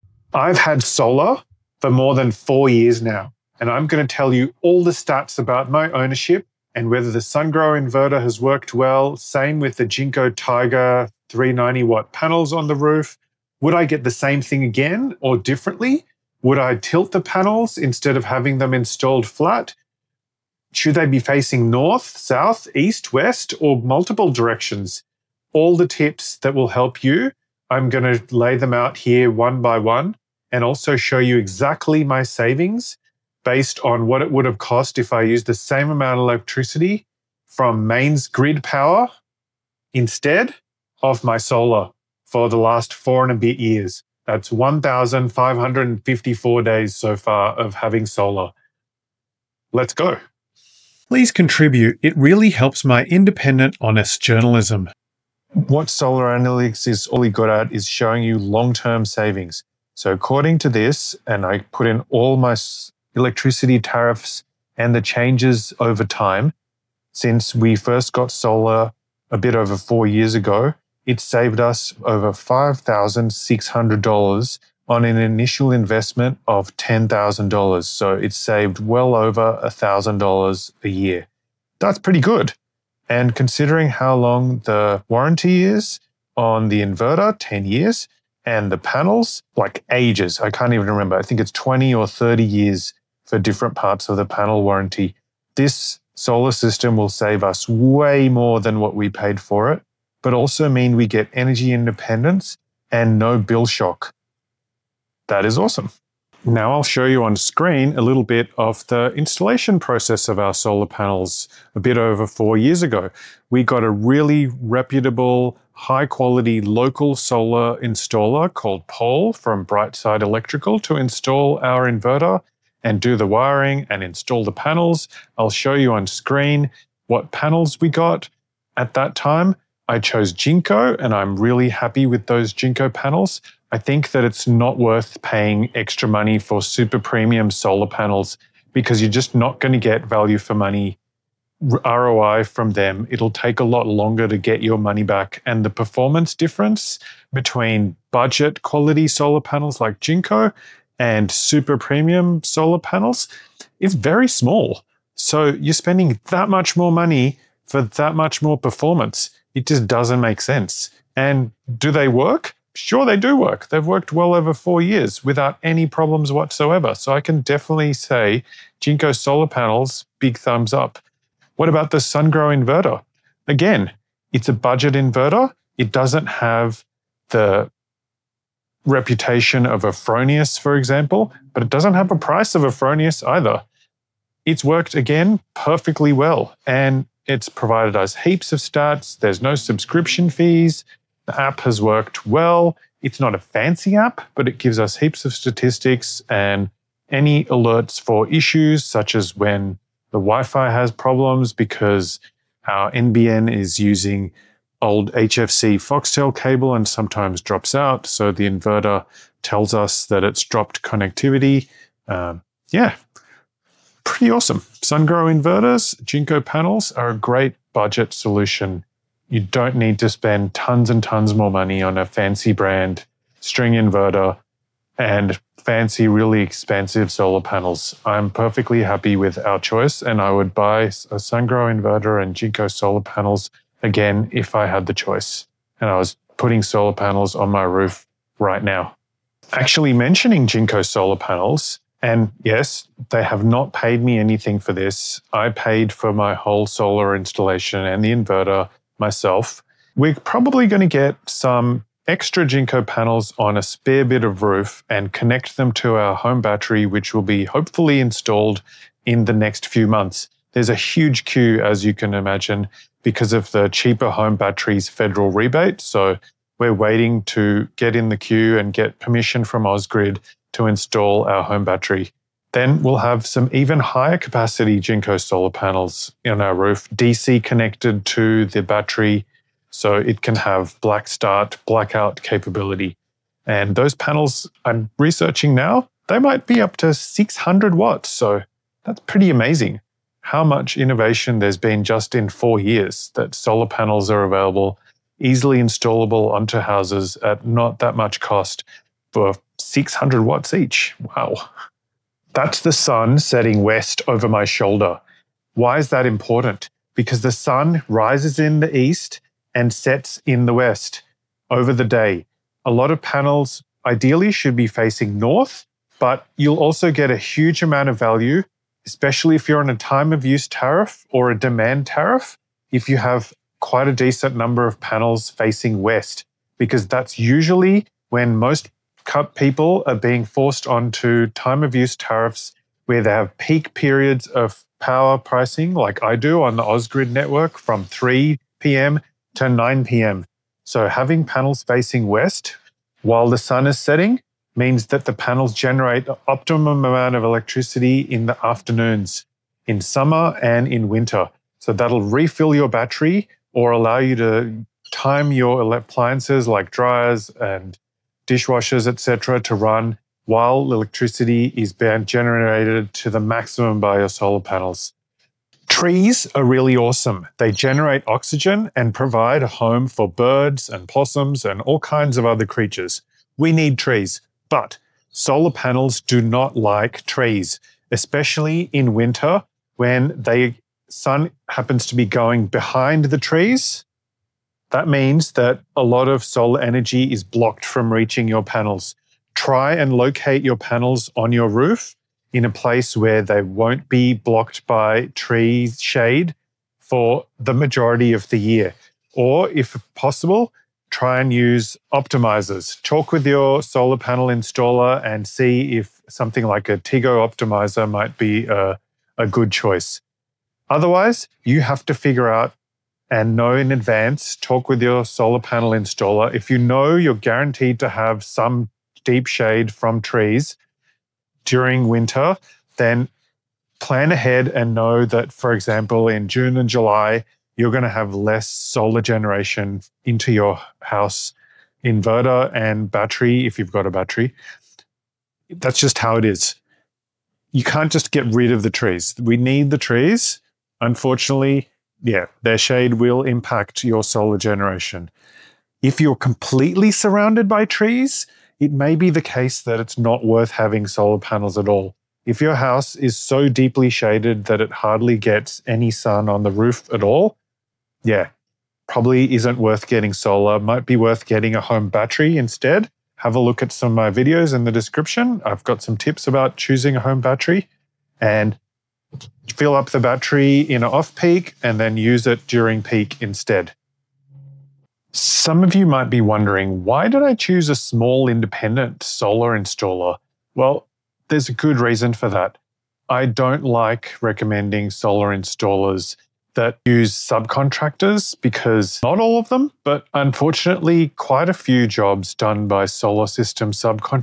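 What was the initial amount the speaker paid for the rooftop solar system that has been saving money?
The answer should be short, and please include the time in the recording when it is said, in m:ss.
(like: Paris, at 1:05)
$10,000, at 1:16.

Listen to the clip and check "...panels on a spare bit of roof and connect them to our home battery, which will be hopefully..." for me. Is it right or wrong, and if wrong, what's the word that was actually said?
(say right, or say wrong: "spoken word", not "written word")
right.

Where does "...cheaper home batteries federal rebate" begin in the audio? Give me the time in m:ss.
4:23.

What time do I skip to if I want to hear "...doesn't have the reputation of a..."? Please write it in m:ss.
2:55.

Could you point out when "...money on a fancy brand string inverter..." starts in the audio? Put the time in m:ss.
3:41.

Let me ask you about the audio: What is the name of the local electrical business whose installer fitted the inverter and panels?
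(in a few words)
Brightside Electrical.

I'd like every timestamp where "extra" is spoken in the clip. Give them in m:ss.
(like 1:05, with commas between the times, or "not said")
2:15, 4:12.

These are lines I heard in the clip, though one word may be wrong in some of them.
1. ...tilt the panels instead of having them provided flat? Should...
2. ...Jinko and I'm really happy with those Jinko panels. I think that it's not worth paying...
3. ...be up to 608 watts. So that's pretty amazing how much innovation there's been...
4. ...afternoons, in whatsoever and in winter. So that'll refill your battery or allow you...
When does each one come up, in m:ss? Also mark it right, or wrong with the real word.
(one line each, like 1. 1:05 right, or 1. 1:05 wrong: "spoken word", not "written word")
1. 0:16 wrong: "installed", not "provided"
2. 2:10 right
3. 4:46 wrong: "600", not "608"
4. 5:48 wrong: "summer", not "whatsoever".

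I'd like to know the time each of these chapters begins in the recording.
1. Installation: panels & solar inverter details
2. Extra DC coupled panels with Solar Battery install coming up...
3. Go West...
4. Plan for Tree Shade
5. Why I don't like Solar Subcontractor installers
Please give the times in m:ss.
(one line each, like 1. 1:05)
1. 1:45
2. 3:58
3. 5:01
4. 6:04
5. 7:53.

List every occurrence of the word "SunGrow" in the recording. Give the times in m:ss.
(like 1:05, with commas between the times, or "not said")
0:07, 2:51, 3:34, 3:51.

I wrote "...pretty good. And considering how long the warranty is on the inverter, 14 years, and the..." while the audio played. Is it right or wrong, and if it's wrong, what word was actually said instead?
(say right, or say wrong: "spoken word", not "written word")
wrong: "10", not "14".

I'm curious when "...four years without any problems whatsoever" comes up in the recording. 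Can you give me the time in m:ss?
2:44.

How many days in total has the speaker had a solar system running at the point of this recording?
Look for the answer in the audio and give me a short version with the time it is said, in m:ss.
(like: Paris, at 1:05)
1,554, at 0:44.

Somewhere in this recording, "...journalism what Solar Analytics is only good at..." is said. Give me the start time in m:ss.
0:54.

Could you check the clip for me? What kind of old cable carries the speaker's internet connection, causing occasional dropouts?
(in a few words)
HFC Foxtel cable.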